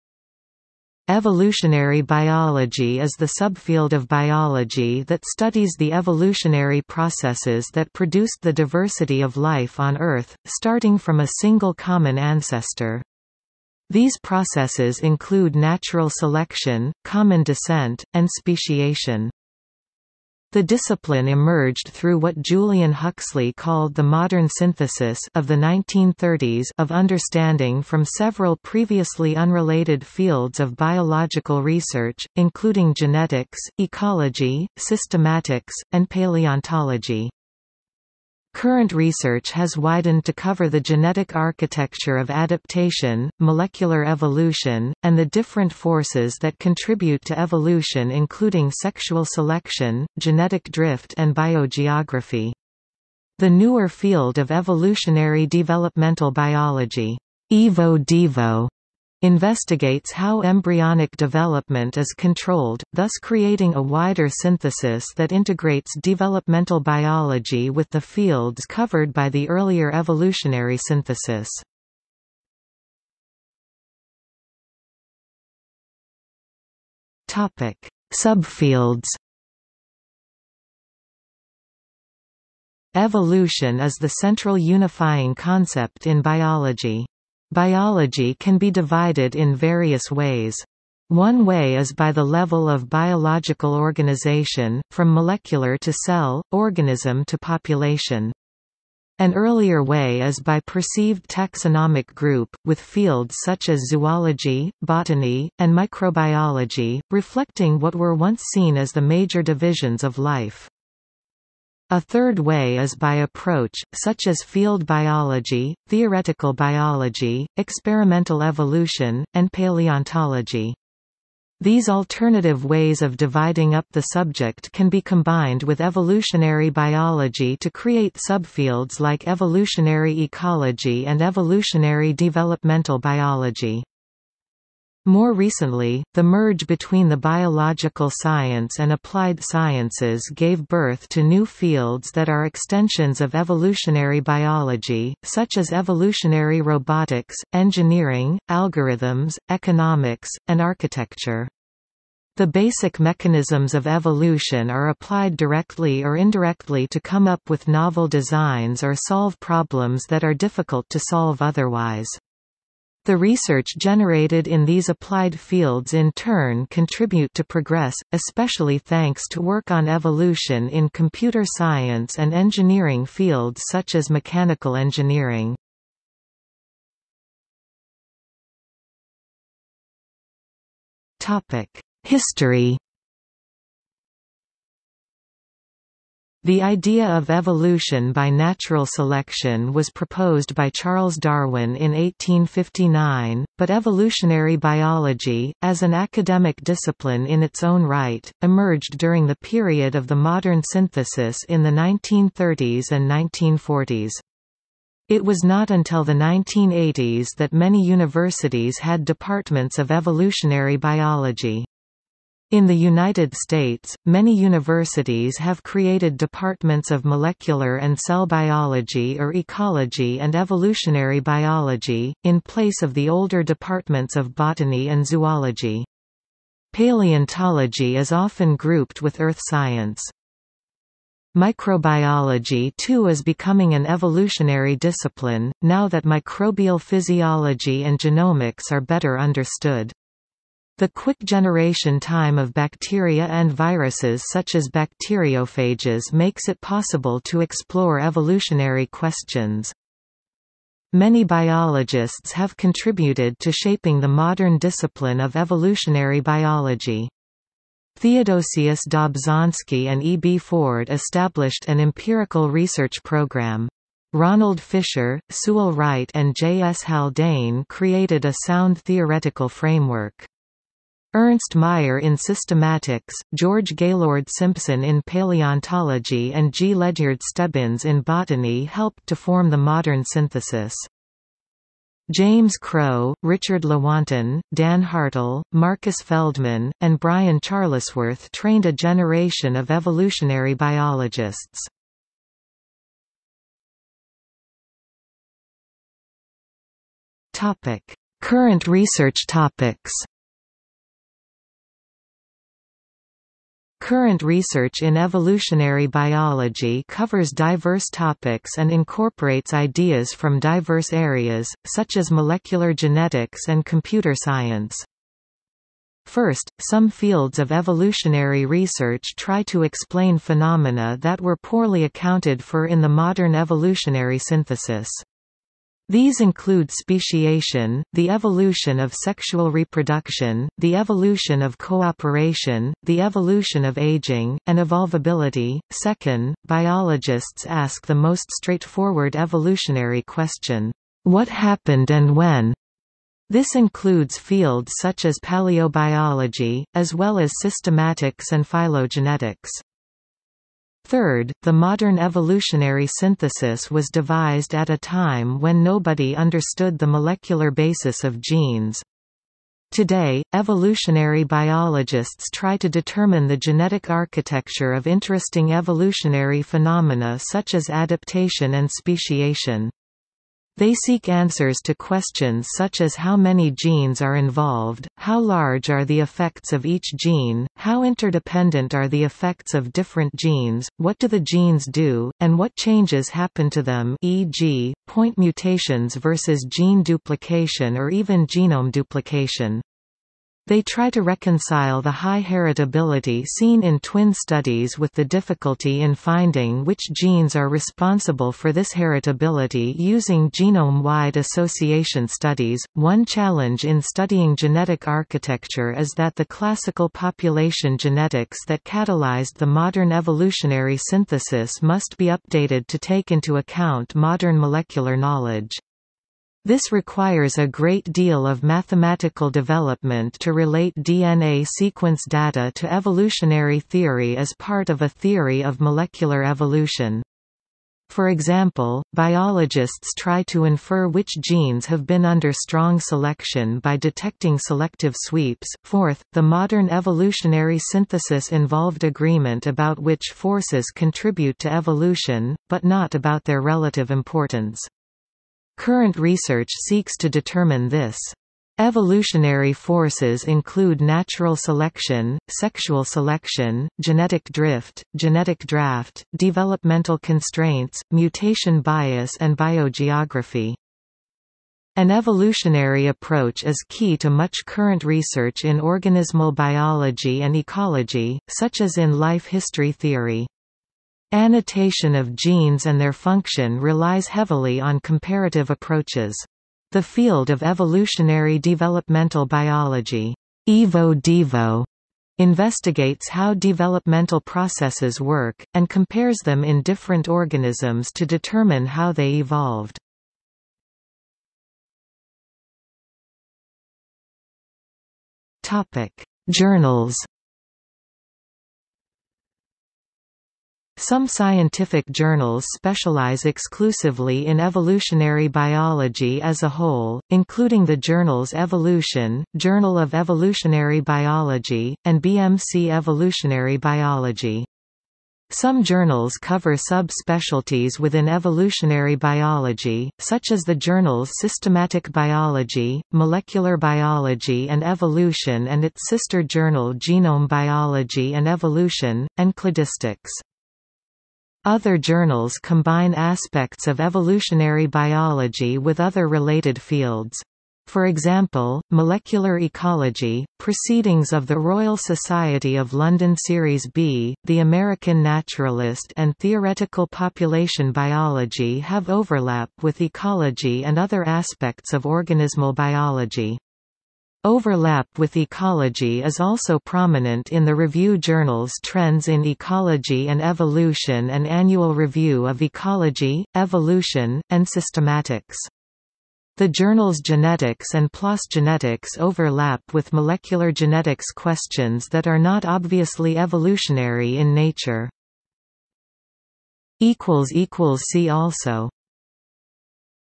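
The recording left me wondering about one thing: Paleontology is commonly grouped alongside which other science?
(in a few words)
earth science.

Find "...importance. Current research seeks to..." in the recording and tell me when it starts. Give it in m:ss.
7:23.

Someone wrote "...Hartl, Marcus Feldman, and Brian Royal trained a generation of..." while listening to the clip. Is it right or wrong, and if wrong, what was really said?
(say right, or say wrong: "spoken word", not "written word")
wrong: "Charlesworth", not "Royal".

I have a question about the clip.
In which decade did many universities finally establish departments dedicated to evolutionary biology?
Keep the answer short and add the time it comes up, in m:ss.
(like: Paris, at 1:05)
1980s, at 3:26.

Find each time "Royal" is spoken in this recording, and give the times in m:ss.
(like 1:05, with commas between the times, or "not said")
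9:01.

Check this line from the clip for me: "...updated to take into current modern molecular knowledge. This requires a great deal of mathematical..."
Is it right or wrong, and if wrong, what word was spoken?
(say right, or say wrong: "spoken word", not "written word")
wrong: "account", not "current".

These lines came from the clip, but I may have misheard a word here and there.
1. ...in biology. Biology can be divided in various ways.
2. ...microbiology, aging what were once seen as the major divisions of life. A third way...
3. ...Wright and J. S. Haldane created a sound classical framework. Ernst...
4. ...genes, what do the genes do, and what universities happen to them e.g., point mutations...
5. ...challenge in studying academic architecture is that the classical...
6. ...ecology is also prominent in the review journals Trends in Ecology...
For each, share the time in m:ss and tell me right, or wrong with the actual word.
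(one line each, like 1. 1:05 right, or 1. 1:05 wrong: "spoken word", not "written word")
1. 1:26 right
2. 1:45 wrong: "reflecting", not "aging"
3. 4:25 wrong: "theoretical", not "classical"
4. 6:20 wrong: "changes", not "universities"
5. 6:43 wrong: "genetic", not "academic"
6. 9:15 right.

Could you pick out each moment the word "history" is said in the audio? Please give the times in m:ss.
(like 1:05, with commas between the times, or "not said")
3:02, 7:49.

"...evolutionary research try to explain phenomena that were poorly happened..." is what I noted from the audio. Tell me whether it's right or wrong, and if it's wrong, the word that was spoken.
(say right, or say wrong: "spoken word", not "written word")
wrong: "accounted", not "happened".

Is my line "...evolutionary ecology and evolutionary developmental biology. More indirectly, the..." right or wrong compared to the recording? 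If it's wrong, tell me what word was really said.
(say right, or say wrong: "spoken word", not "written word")
wrong: "recently", not "indirectly".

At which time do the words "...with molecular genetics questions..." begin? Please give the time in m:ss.
9:29.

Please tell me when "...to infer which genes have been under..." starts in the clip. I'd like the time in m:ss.
7:10.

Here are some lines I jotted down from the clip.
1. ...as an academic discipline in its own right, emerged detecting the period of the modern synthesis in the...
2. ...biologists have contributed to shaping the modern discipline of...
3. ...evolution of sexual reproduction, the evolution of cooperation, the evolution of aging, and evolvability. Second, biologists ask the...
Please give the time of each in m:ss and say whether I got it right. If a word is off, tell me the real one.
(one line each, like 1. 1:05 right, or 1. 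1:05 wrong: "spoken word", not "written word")
1. 3:15 wrong: "during", not "detecting"
2. 4:11 right
3. 5:28 right.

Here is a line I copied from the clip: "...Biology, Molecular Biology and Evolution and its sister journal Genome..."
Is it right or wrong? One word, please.
right.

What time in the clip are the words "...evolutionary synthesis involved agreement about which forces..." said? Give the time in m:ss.
7:16.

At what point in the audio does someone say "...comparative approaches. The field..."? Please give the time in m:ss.
7:54.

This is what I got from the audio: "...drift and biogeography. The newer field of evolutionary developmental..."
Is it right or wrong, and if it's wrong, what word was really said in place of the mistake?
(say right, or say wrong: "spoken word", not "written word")
right.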